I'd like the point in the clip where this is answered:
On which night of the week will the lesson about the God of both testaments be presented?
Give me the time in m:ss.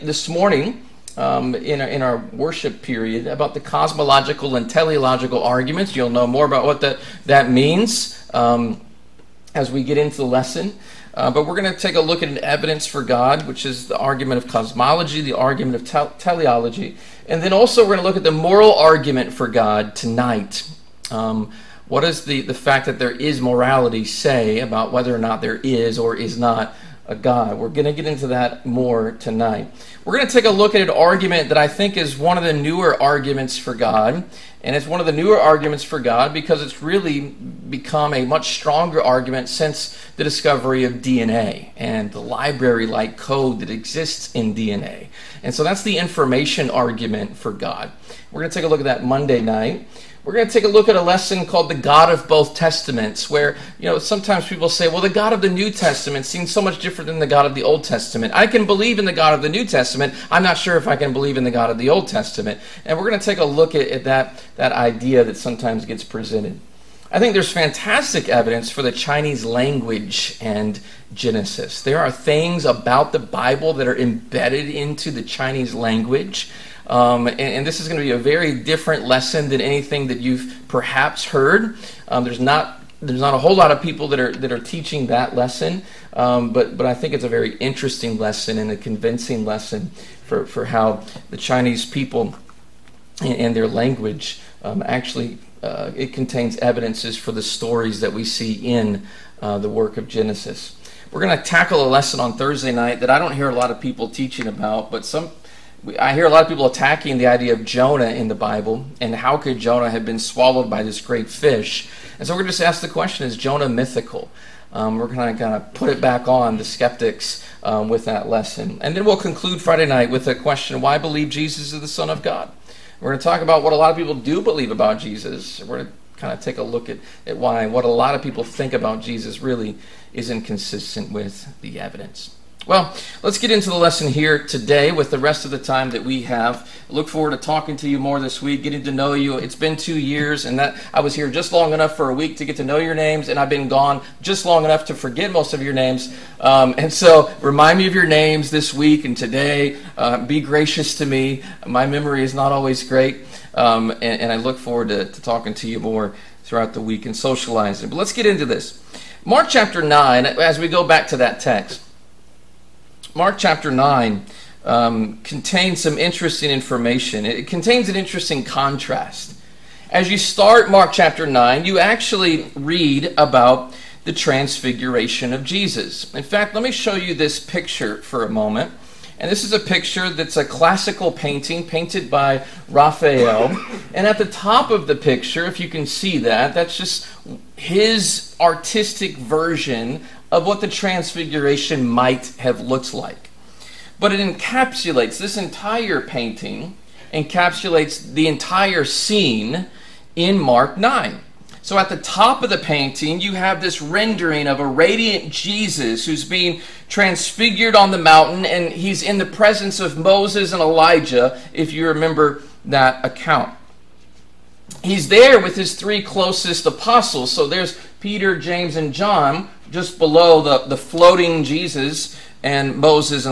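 0:49.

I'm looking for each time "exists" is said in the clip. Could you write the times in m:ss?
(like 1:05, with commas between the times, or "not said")
0:43.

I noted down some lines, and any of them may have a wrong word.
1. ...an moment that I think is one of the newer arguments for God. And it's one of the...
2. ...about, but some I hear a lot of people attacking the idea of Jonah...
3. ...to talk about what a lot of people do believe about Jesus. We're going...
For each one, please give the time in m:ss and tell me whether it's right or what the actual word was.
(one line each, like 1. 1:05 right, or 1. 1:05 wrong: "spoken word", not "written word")
1. 0:30 wrong: "argument", not "moment"
2. 1:44 right
3. 2:03 right.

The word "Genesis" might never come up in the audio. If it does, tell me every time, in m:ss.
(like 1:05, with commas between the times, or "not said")
1:11, 1:40.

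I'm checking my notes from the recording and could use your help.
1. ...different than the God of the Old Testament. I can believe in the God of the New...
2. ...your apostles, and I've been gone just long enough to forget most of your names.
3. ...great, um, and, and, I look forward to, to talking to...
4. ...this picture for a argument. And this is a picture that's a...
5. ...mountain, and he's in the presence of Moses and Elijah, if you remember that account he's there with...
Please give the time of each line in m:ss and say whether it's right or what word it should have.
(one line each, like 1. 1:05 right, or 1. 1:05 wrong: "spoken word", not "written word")
1. 0:56 right
2. 2:22 wrong: "names", not "apostles"
3. 2:32 right
4. 2:57 wrong: "moment", not "argument"
5. 3:27 right.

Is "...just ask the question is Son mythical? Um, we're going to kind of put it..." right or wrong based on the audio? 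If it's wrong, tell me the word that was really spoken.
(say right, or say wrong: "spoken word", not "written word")
wrong: "Jonah", not "Son".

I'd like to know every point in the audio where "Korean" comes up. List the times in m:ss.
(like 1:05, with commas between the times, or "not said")
not said.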